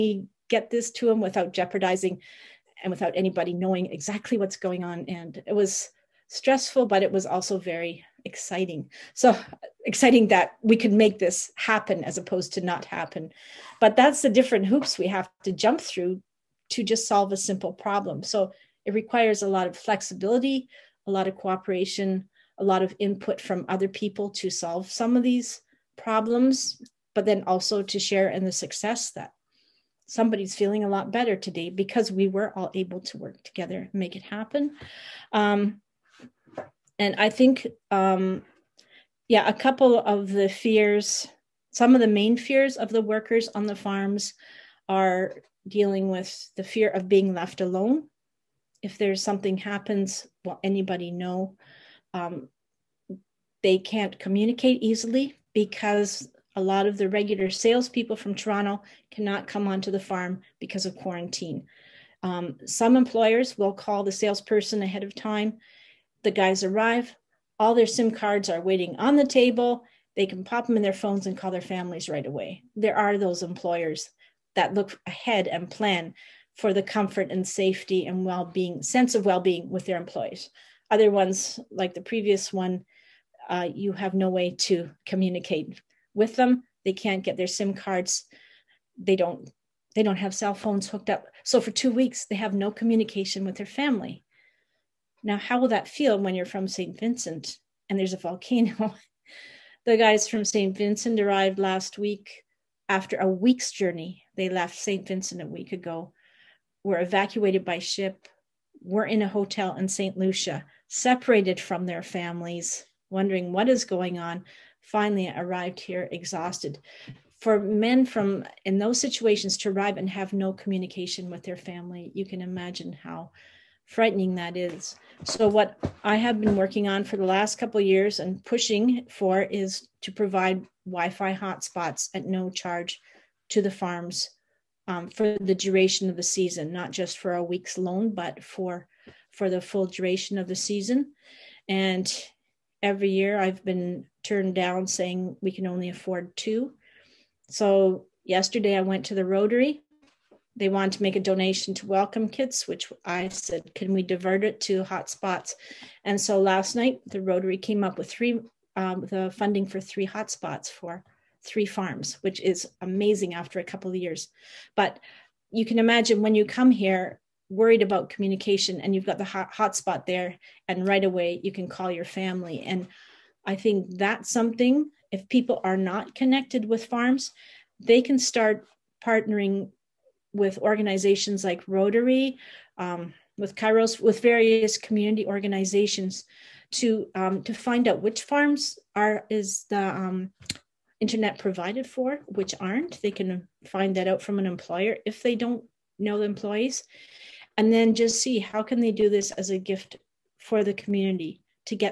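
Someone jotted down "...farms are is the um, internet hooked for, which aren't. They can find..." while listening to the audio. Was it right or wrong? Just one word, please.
wrong.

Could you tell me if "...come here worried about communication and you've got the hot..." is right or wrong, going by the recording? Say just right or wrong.
right.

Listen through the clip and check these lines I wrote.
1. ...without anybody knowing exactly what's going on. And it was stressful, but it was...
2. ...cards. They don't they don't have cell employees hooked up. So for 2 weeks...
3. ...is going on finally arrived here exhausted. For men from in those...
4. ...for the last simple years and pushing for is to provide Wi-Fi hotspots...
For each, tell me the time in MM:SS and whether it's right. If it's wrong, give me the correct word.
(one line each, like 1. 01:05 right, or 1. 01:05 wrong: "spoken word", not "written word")
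1. 00:02 right
2. 01:27 wrong: "phones", not "employees"
3. 01:53 right
4. 02:07 wrong: "couple", not "simple".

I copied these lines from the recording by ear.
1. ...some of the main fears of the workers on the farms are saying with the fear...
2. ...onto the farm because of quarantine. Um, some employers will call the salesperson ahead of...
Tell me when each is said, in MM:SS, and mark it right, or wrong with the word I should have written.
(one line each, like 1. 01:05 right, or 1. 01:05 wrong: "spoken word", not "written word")
1. 00:41 wrong: "dealing", not "saying"
2. 00:59 right.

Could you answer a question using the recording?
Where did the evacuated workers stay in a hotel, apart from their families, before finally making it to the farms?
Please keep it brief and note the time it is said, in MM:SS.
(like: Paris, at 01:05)
St. Lucia, at 01:49.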